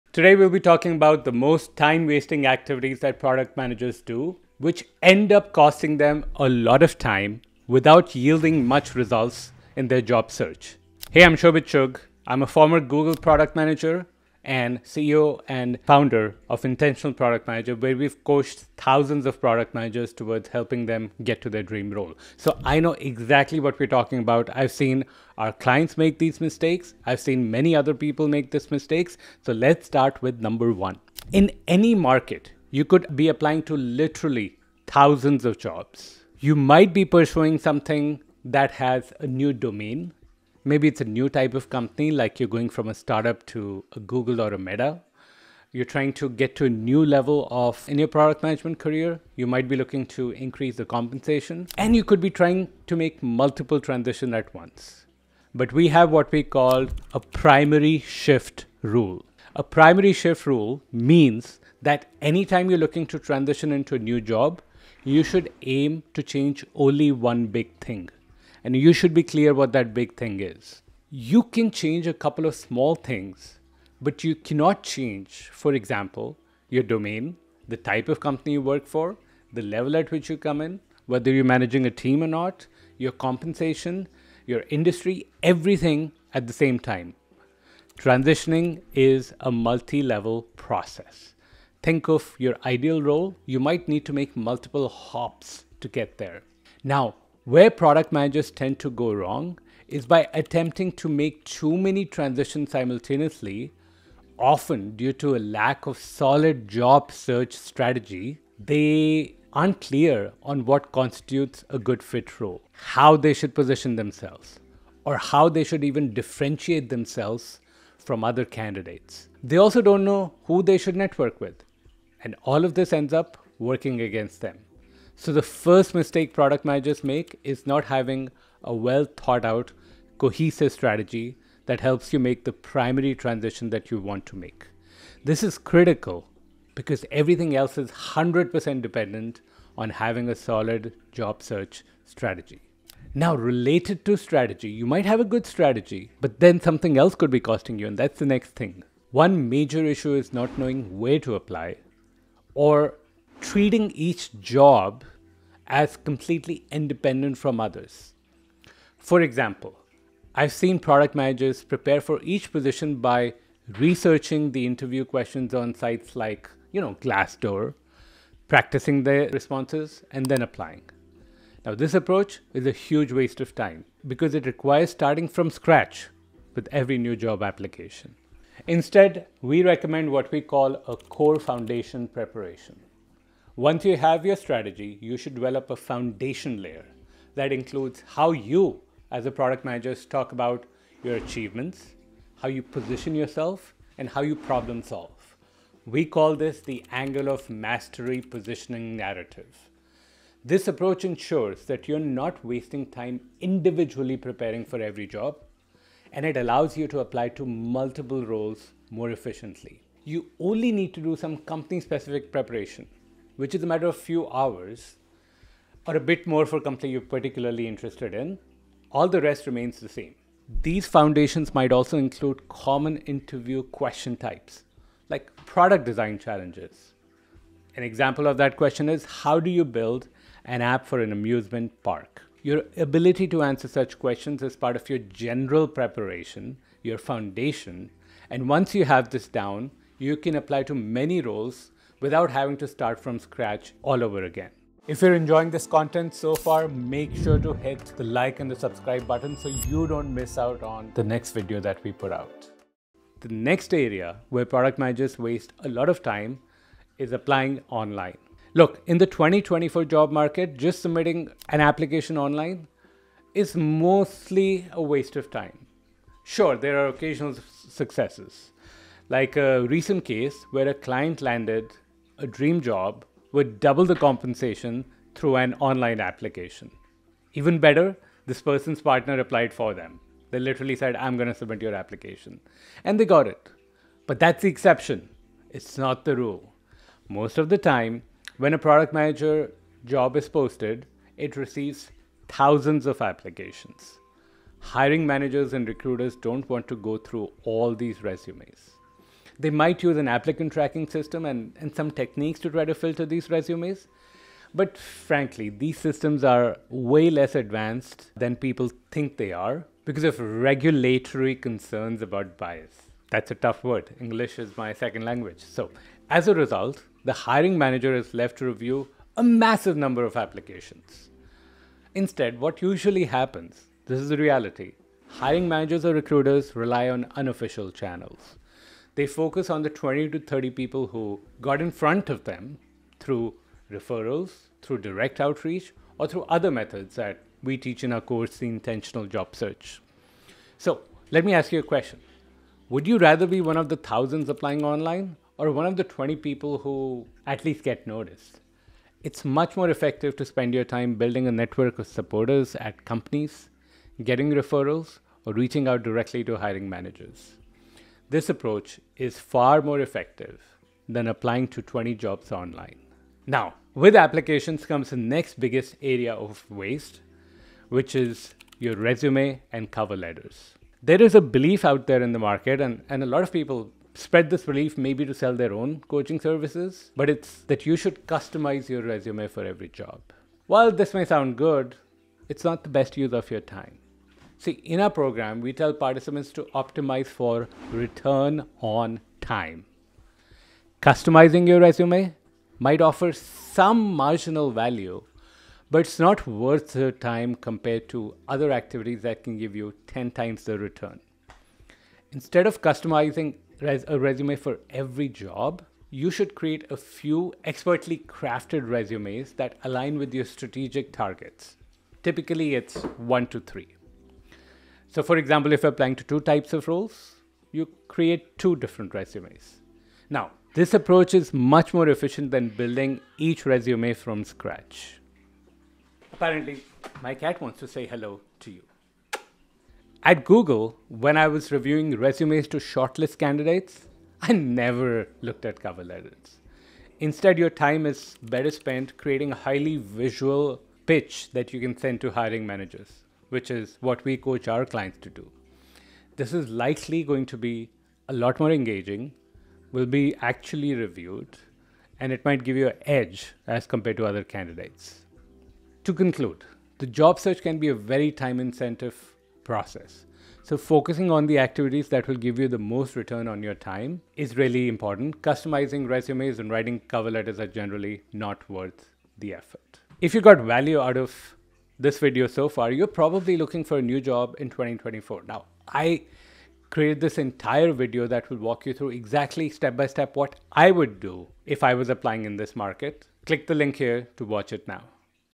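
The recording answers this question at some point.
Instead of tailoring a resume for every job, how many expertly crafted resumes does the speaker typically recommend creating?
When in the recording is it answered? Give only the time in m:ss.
6:53.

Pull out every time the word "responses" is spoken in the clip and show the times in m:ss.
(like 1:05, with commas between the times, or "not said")
2:49.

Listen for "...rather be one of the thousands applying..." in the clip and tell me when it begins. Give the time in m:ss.
5:42.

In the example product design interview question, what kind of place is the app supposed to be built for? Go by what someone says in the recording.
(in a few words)
amusement park.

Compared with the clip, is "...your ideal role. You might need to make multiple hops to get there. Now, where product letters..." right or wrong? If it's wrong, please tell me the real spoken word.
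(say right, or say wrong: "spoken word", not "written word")
wrong: "managers", not "letters".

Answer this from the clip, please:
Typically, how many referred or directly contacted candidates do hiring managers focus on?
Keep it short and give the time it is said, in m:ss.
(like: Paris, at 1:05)
20 to 30, at 5:29.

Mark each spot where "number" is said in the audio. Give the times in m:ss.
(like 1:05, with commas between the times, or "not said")
0:30, 5:19.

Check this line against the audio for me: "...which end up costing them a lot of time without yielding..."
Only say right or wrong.
right.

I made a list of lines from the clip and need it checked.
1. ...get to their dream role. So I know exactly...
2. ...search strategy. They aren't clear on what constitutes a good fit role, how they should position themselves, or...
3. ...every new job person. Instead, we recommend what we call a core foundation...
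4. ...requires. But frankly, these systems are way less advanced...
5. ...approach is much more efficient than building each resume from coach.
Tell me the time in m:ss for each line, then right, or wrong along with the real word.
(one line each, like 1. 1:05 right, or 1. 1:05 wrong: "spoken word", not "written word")
1. 0:21 right
2. 1:47 right
3. 2:56 wrong: "application", not "person"
4. 5:03 wrong: "resumes", not "requires"
5. 7:00 wrong: "scratch", not "coach".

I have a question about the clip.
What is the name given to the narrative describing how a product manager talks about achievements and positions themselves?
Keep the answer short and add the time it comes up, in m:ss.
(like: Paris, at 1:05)
angle of mastery positioning narrative, at 3:16.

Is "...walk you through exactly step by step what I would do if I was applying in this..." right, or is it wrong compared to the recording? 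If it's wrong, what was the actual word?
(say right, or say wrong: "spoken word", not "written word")
right.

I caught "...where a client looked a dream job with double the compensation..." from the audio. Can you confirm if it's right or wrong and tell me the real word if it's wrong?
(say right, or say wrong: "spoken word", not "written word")
wrong: "landed", not "looked".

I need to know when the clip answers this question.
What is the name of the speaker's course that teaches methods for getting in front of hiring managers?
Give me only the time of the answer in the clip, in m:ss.
5:38.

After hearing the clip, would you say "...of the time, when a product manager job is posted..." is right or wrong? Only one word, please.
right.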